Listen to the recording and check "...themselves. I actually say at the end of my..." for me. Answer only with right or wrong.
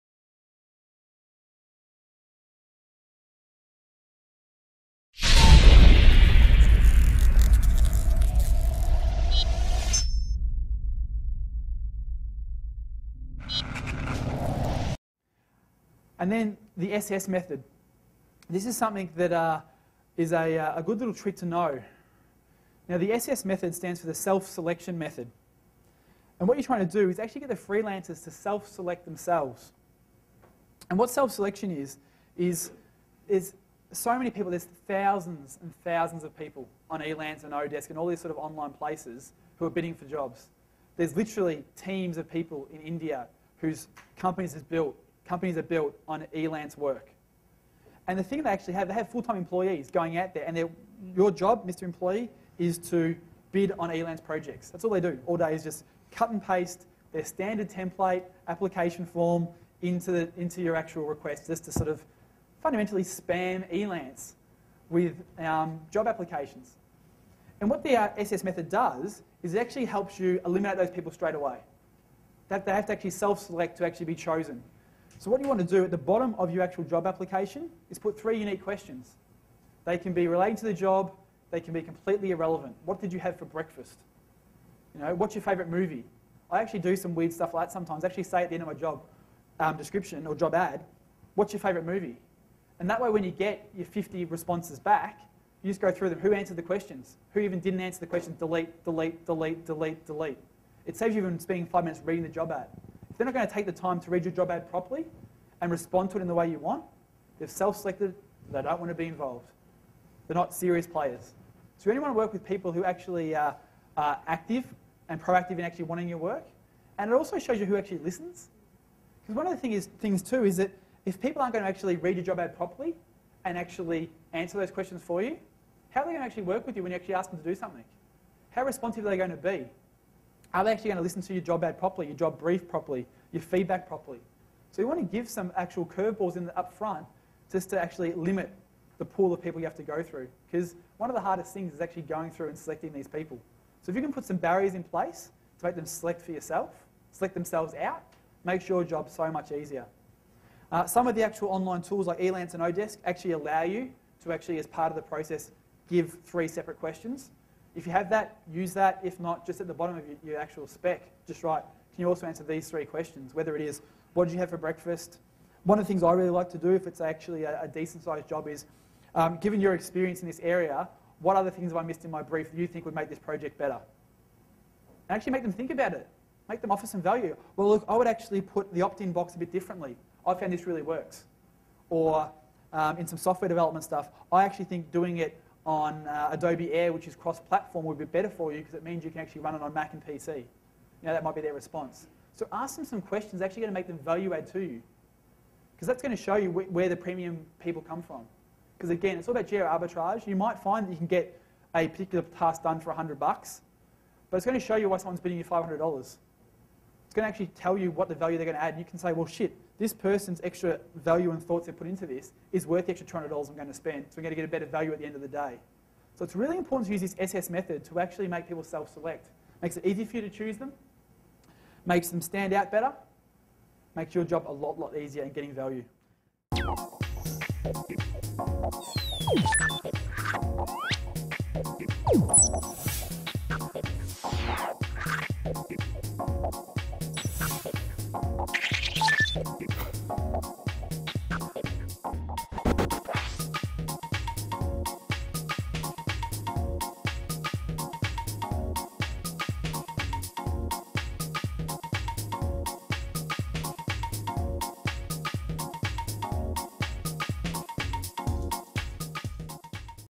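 wrong.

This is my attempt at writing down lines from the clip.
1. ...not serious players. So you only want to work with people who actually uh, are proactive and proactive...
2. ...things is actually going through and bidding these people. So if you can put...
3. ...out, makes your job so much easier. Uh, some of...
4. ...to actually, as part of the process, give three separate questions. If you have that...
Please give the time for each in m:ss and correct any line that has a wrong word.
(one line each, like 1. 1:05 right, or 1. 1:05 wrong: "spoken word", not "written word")
1. 1:50 wrong: "active", not "proactive"
2. 2:21 wrong: "selecting", not "bidding"
3. 2:27 right
4. 2:34 right.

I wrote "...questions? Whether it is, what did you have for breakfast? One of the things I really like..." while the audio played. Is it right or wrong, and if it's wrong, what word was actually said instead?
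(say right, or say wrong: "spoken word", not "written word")
right.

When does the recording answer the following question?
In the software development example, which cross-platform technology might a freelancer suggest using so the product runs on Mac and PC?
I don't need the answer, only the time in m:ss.
3:06.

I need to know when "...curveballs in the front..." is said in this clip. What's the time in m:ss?
2:15.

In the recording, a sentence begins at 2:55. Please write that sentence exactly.
And actually make them think about it.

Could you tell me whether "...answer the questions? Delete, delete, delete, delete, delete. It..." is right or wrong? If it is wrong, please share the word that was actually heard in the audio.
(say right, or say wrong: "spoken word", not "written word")
right.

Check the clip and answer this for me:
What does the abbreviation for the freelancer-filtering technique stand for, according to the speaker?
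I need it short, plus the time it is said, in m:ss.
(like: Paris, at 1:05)
self-selection method, at 0:24.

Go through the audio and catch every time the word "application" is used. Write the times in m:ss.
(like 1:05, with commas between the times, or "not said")
0:58, 1:06, 1:17.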